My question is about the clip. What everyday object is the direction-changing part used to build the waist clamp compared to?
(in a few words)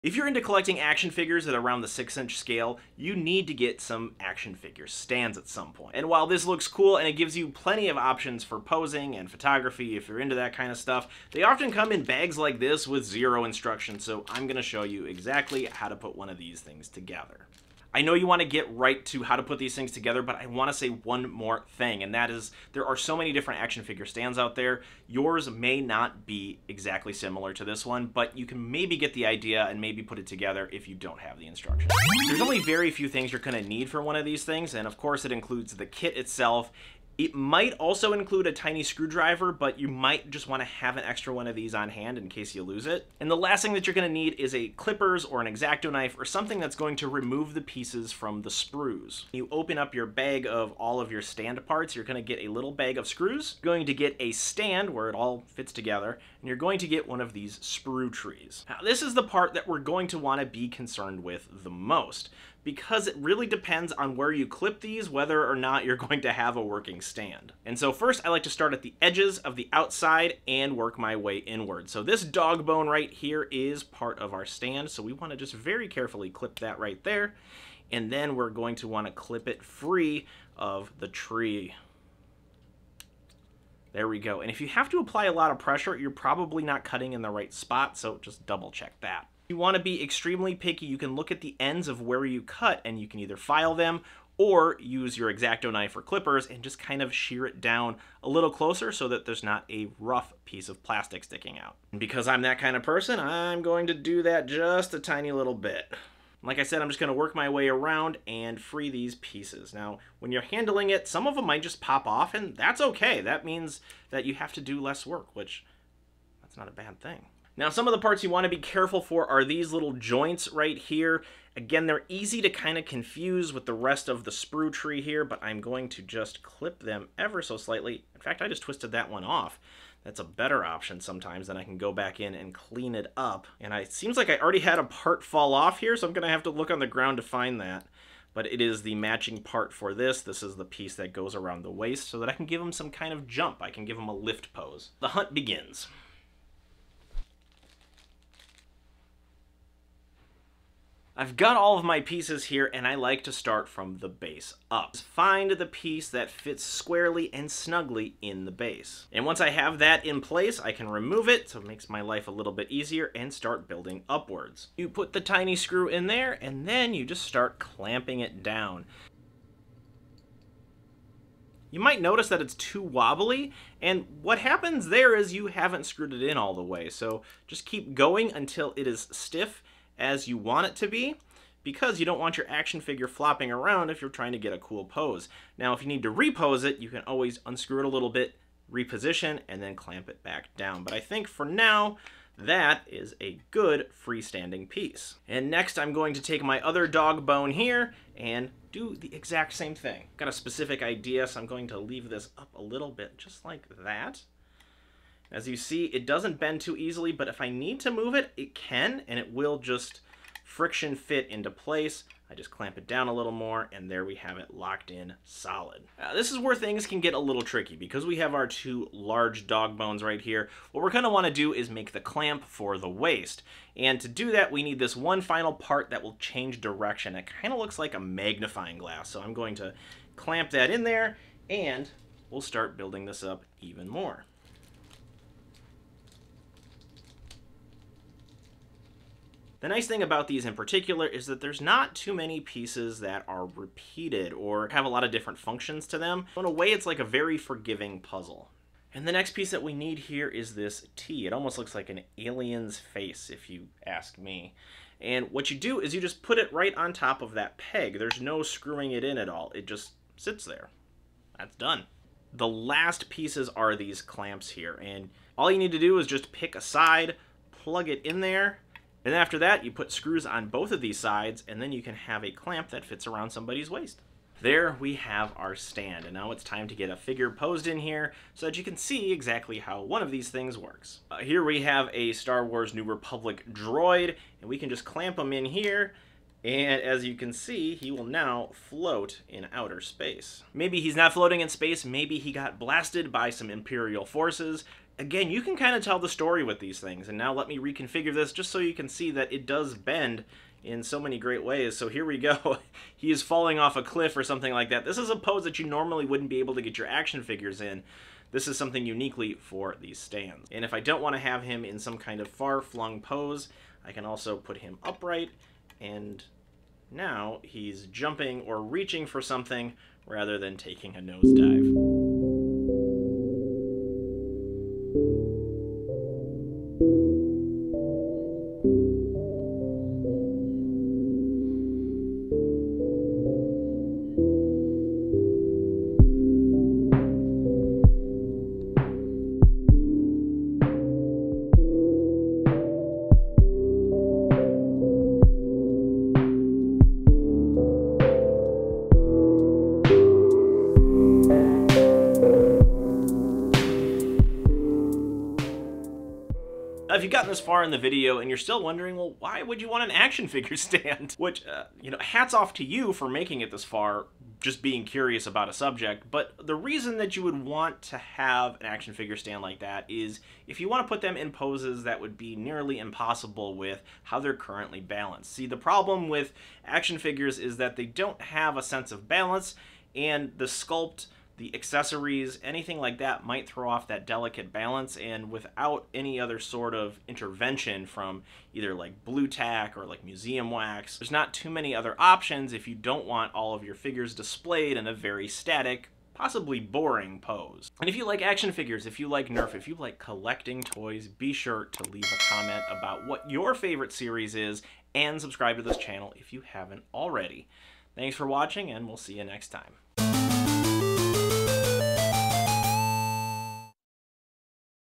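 magnifying glass.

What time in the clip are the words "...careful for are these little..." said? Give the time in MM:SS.
01:58.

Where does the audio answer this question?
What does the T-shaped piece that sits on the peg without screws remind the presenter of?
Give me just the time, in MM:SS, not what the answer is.
04:11.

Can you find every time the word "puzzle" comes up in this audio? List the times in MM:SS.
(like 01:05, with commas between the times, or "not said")
04:07.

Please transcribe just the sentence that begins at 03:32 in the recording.
I just clamp it down a little more, and there we have it locked in solid.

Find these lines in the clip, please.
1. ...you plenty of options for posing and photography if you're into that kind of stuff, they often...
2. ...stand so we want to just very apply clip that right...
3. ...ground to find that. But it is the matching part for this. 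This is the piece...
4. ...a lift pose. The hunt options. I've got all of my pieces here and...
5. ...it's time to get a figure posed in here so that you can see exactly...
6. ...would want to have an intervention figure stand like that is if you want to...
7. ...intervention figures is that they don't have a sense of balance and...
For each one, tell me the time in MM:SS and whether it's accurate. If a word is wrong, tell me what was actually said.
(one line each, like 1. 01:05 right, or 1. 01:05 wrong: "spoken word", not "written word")
1. 00:07 right
2. 01:14 wrong: "carefully", not "apply"
3. 02:16 right
4. 02:24 wrong: "begins", not "options"
5. 04:36 right
6. 06:07 wrong: "action", not "intervention"
7. 06:16 wrong: "action", not "intervention".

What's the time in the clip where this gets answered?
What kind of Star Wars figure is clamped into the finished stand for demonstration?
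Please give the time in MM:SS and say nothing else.
04:42.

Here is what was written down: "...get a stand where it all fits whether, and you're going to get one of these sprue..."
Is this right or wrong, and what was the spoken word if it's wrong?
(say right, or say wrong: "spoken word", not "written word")
wrong: "together", not "whether".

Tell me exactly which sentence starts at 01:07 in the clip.
And so first I like to start at the edges of the outside and work my way inward.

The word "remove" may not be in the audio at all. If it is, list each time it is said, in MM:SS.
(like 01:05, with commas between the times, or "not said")
00:47, 02:40.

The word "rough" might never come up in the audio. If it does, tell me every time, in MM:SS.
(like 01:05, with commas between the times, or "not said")
01:39.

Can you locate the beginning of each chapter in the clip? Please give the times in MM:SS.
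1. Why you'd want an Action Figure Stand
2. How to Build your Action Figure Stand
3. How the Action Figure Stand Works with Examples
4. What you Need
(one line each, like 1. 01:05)
1. 05:56
2. 00:58
3. 04:36
4. 00:33.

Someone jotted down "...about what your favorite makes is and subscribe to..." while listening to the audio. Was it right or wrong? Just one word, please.
wrong.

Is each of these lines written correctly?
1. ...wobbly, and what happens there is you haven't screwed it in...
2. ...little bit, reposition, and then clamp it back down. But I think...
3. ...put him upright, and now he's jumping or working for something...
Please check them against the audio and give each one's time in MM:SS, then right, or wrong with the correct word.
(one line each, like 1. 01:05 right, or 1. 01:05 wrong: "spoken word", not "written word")
1. 02:52 right
2. 03:07 right
3. 05:14 wrong: "reaching", not "working".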